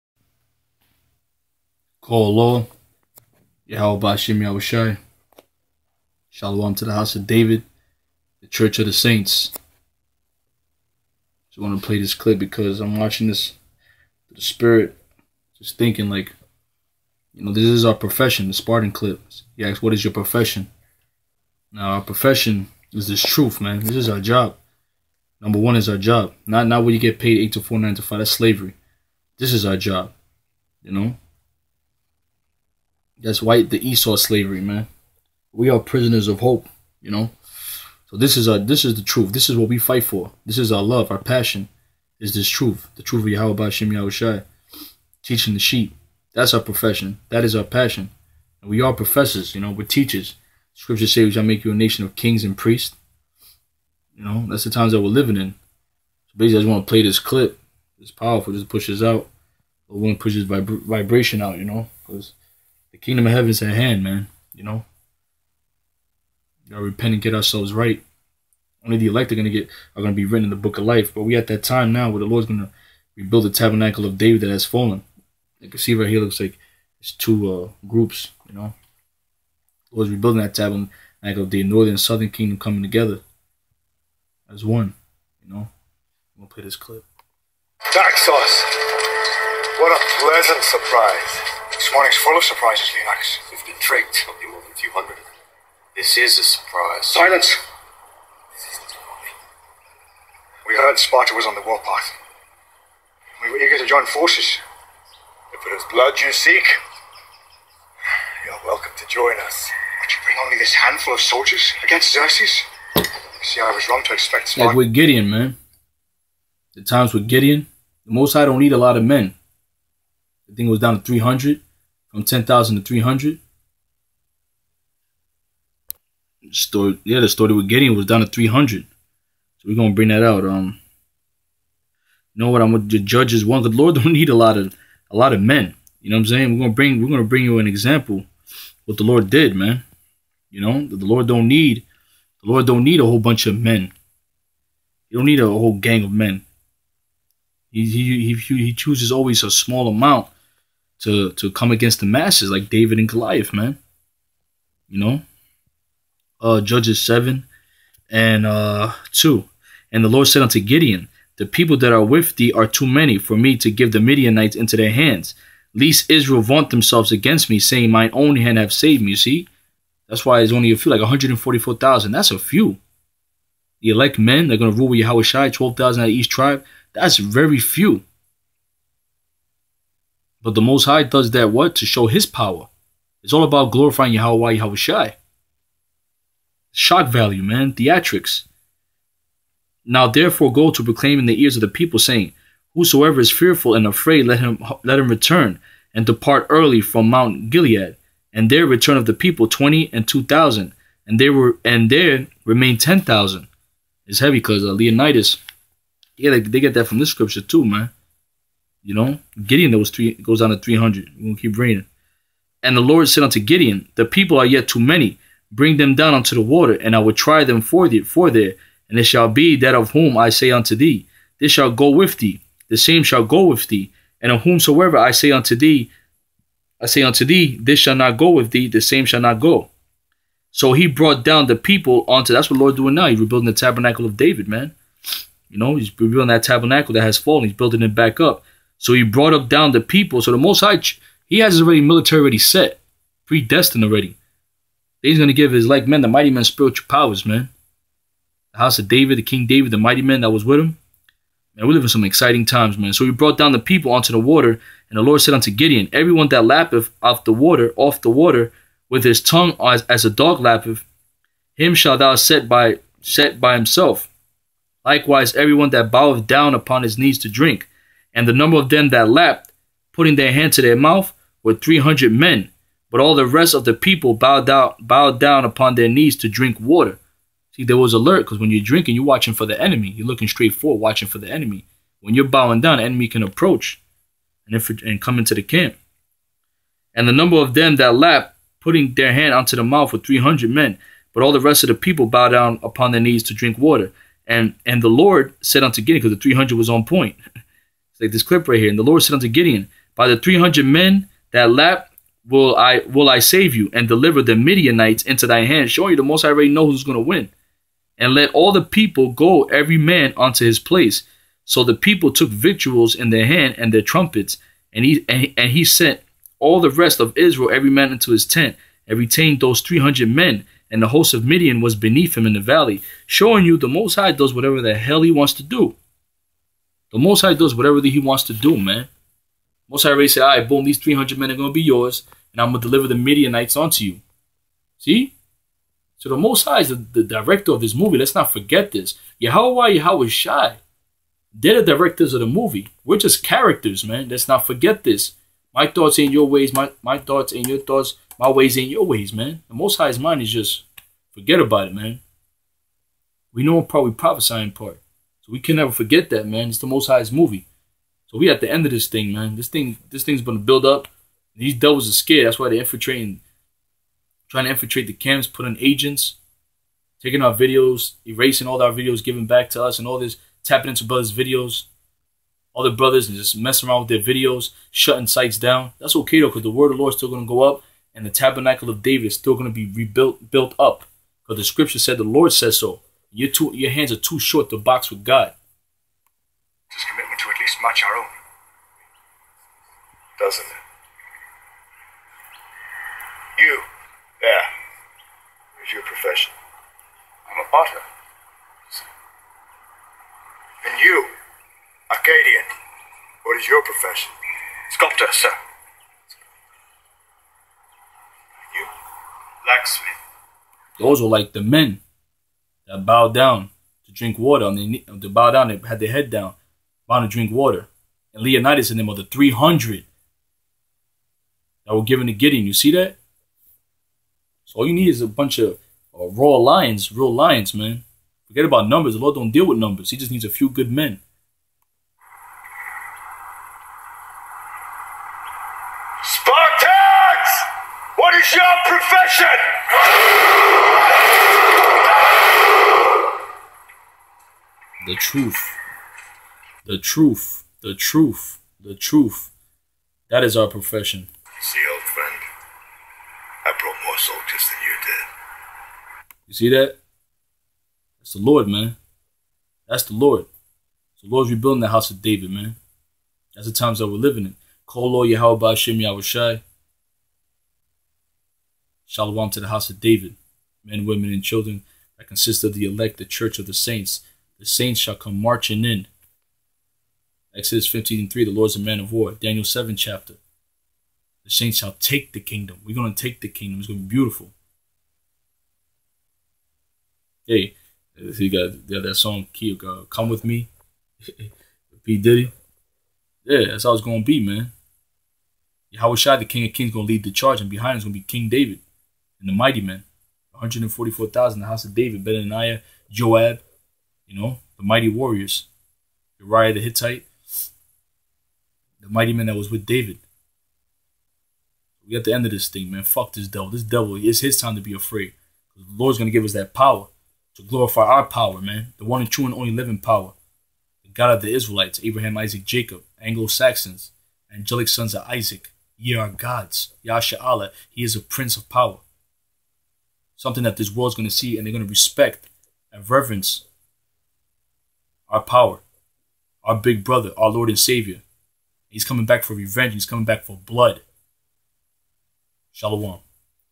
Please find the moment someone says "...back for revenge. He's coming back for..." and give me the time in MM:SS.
08:59.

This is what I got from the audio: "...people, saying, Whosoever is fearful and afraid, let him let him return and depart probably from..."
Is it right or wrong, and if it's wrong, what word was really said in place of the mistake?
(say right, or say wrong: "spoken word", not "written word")
wrong: "early", not "probably".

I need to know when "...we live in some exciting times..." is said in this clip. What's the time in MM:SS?
04:11.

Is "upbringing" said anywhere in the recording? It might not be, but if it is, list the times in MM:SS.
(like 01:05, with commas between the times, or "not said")
not said.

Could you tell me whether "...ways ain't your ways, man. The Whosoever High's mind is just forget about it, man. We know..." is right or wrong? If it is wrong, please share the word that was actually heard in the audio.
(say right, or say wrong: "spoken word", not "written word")
wrong: "Most", not "Whosoever".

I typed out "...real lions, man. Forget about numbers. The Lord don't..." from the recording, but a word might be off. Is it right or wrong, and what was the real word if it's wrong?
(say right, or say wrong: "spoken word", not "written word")
right.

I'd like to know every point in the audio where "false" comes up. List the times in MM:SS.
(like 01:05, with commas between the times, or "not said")
not said.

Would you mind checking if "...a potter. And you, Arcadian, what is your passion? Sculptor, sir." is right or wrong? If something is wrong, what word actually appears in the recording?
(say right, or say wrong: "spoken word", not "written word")
wrong: "profession", not "passion".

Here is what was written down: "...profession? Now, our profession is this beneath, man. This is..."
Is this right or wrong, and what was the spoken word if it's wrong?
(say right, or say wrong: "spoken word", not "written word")
wrong: "truth", not "beneath".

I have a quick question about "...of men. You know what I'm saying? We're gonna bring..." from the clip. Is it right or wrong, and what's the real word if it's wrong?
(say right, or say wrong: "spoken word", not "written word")
right.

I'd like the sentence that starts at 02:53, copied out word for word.
The elect men, they're going to rule with Yahweh Shai, 12,000 out of each tribe.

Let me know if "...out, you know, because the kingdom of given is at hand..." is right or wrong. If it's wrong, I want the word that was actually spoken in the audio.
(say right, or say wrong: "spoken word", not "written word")
wrong: "heaven", not "given".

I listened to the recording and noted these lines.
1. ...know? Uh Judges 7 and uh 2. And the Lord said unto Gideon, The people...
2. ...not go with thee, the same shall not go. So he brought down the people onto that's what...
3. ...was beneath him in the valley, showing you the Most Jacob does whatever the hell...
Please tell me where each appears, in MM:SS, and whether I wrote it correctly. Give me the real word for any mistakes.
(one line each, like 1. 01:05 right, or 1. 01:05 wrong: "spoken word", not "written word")
1. 02:34 right
2. 03:47 right
3. 05:21 wrong: "High", not "Jacob".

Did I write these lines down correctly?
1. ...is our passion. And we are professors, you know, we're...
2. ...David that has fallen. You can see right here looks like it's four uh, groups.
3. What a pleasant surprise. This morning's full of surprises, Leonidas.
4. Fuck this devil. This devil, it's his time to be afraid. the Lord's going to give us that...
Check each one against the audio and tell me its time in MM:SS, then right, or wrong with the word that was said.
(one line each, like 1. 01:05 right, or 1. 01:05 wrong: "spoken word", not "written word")
1. 00:47 right
2. 01:14 wrong: "two", not "four"
3. 01:29 right
4. 08:32 right.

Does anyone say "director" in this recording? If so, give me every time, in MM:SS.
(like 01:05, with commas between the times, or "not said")
05:37, 05:41.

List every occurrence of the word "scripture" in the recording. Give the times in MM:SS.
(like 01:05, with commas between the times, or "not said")
00:50, 03:27, 06:21.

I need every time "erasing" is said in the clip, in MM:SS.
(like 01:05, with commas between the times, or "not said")
06:08.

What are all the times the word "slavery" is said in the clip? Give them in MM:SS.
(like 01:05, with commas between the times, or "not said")
00:28, 00:34.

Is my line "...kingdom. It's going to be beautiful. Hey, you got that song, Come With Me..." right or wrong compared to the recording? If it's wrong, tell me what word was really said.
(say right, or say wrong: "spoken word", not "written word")
right.